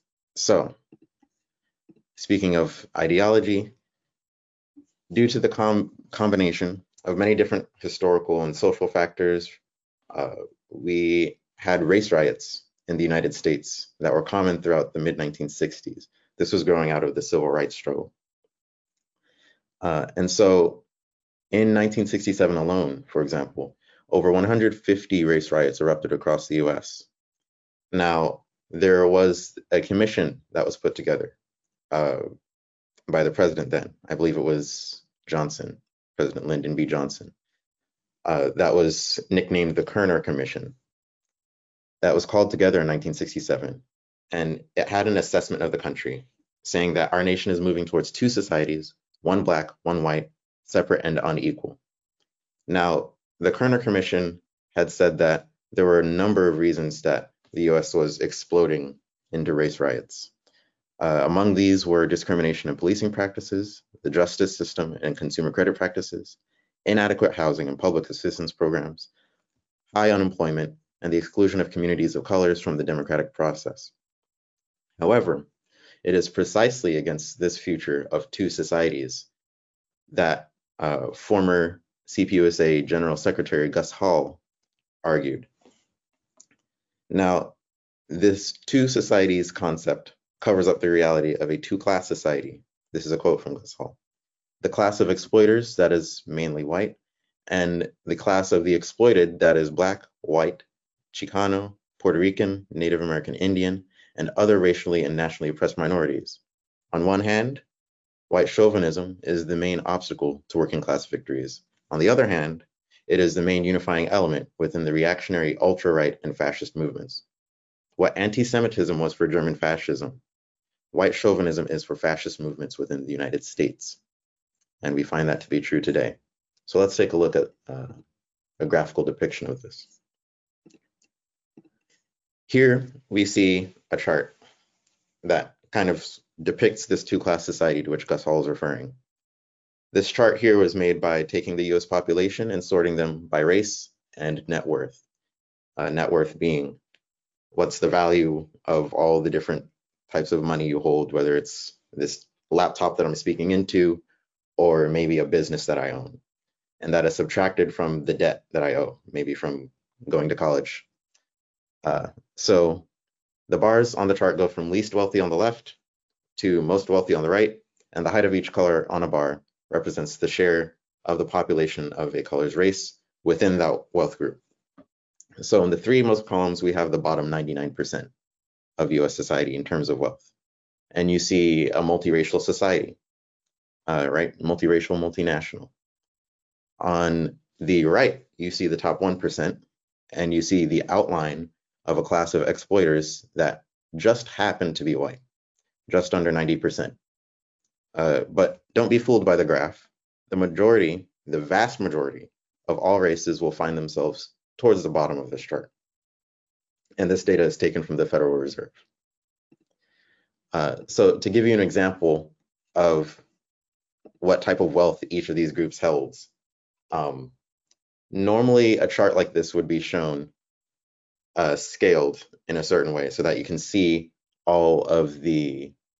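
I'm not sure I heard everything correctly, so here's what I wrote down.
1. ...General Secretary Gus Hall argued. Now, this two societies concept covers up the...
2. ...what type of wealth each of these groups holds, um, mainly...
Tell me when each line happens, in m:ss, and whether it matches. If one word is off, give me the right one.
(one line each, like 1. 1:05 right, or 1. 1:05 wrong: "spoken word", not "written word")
1. 1:22 right
2. 3:34 wrong: "normally", not "mainly".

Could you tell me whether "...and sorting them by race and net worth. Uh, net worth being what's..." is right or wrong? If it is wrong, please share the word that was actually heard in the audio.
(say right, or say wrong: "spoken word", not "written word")
right.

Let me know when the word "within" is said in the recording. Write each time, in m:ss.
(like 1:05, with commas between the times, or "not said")
1:54, 2:02, 2:53.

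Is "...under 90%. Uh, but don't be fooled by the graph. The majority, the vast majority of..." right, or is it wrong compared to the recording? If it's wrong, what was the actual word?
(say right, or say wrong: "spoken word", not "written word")
right.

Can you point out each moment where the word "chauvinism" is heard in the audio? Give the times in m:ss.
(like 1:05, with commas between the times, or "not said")
1:48, 2:01.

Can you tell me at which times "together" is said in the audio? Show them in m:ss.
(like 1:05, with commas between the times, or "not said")
0:30, 0:42.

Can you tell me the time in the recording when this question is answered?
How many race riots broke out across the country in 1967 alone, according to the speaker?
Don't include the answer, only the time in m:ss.
0:24.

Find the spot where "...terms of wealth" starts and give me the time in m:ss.
2:59.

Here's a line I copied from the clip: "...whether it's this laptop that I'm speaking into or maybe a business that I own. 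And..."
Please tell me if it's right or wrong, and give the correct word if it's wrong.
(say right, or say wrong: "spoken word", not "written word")
right.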